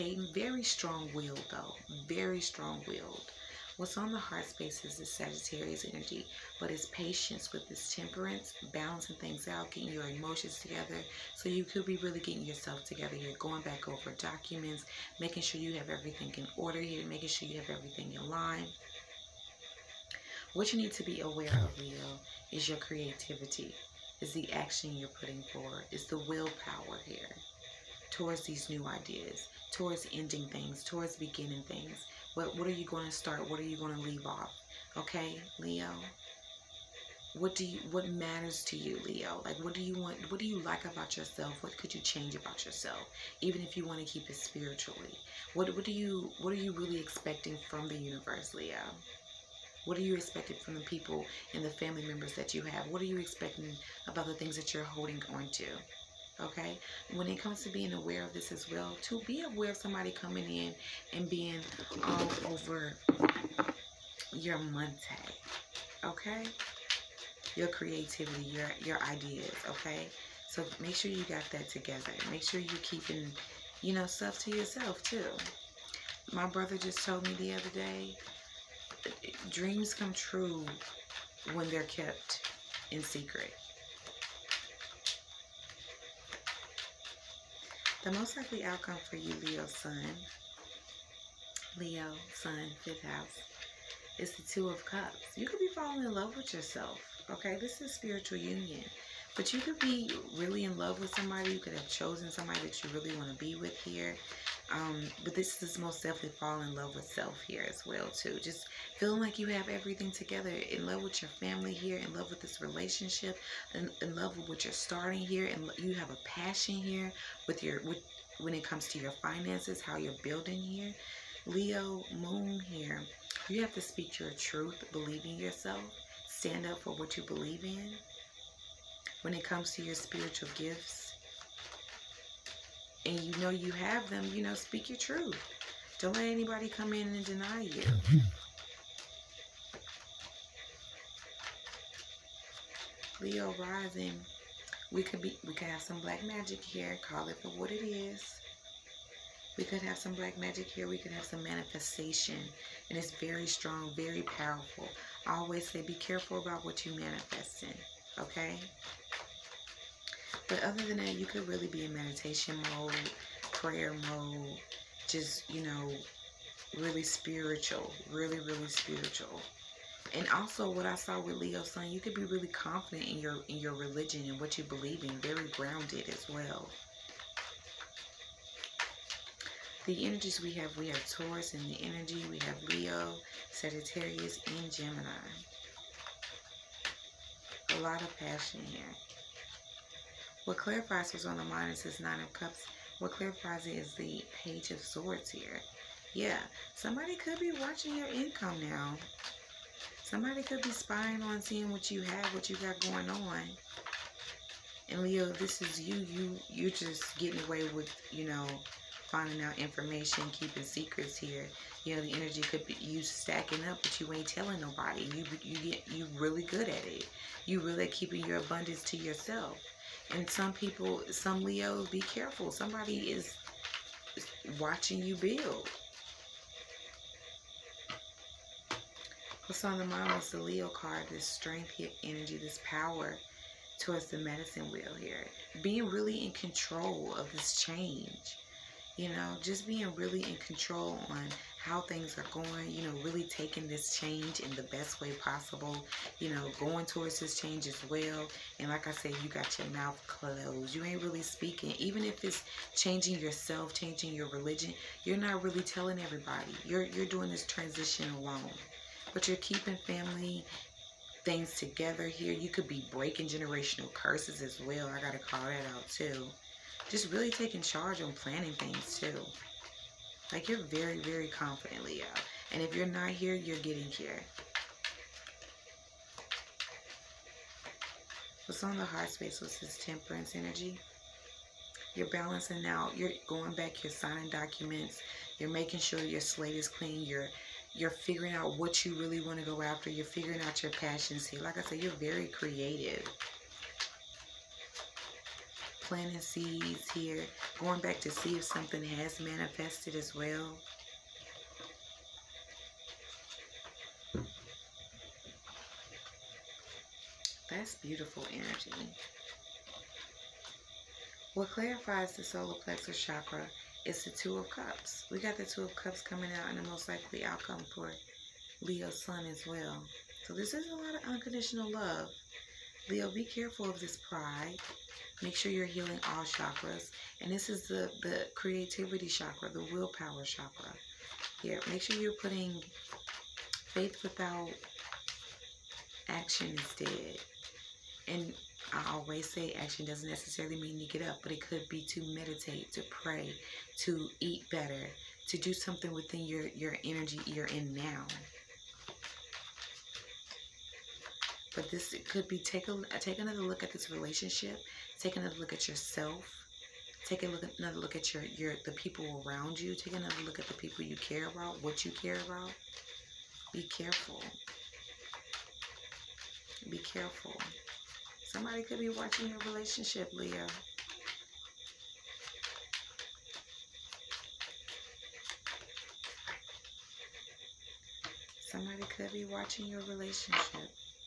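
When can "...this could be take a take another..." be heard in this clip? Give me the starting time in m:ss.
5:51.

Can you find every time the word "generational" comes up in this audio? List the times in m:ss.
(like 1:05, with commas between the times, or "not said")
4:23.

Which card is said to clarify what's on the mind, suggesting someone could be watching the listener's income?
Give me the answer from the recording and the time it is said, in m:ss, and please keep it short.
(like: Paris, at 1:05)
Page of Swords, at 3:14.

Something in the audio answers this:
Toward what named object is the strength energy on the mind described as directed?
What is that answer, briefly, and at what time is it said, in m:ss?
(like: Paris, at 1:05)
medicine wheel, at 3:54.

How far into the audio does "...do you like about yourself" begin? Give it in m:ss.
0:40.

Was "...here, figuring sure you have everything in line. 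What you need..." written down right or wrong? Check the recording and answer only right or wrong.
wrong.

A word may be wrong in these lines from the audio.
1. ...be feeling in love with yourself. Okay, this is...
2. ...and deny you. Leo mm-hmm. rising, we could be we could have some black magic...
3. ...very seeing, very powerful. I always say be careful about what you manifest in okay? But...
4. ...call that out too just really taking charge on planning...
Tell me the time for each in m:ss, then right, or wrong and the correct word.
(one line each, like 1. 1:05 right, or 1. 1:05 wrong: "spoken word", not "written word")
1. 1:35 wrong: "falling", not "feeling"
2. 2:17 right
3. 2:33 wrong: "strong", not "seeing"
4. 4:25 right.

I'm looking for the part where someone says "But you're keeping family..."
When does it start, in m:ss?
4:19.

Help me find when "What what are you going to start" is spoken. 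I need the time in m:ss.
0:32.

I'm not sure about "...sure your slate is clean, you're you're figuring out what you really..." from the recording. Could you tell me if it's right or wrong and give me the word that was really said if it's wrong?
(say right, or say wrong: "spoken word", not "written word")
right.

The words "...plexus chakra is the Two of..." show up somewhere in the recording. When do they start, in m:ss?
5:12.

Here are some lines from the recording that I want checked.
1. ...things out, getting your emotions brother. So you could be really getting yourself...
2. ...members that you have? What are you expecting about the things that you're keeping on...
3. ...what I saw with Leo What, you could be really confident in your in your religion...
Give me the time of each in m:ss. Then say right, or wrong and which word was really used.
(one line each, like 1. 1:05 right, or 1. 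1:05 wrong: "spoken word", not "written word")
1. 0:09 wrong: "together", not "brother"
2. 0:52 wrong: "holding", not "keeping"
3. 2:50 wrong: "Sun", not "What".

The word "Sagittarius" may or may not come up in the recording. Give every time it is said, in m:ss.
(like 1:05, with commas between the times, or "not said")
0:05, 3:03.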